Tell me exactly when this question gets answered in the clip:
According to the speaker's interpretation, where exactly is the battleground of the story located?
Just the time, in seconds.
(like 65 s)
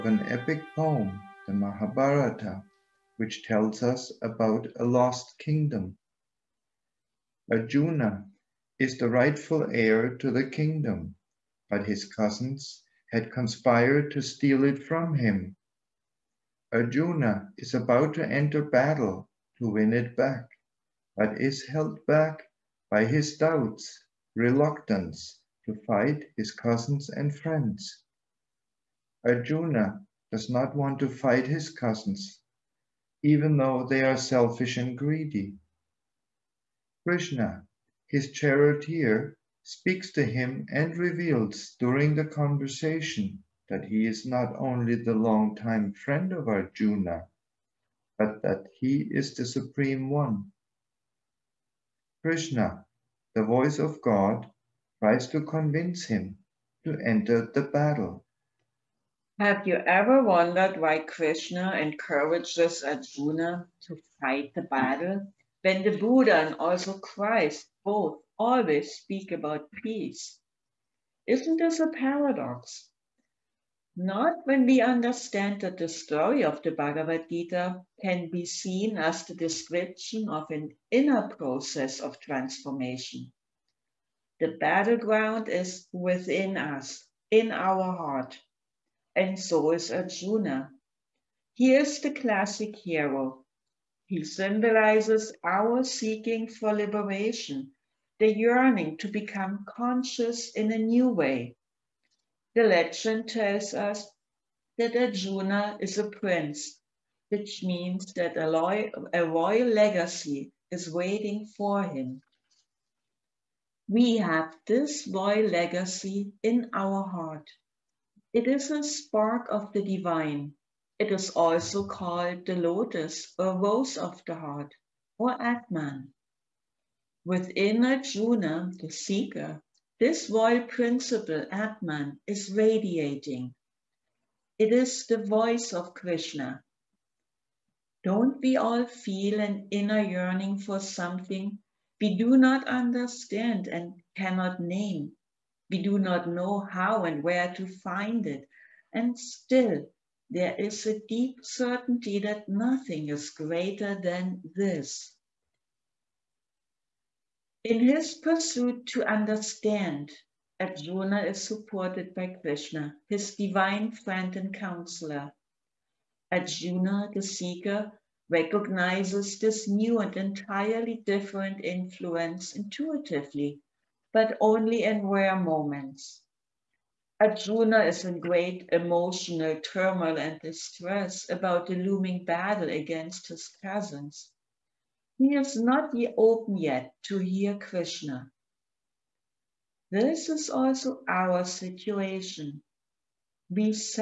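85 s.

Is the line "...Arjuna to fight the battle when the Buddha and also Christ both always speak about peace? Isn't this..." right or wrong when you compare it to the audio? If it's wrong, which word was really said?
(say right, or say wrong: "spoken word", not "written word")
right.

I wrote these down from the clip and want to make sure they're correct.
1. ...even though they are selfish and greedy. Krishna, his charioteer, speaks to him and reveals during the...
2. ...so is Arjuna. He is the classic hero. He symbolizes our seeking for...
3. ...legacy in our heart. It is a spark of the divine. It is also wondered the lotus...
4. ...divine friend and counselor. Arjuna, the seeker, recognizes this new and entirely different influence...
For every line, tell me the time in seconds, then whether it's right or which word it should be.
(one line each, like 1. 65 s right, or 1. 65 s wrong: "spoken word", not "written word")
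1. 33 s right
2. 89 s right
3. 115 s wrong: "called", not "wondered"
4. 163 s right.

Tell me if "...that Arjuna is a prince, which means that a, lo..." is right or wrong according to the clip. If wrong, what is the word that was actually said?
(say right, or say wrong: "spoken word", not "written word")
right.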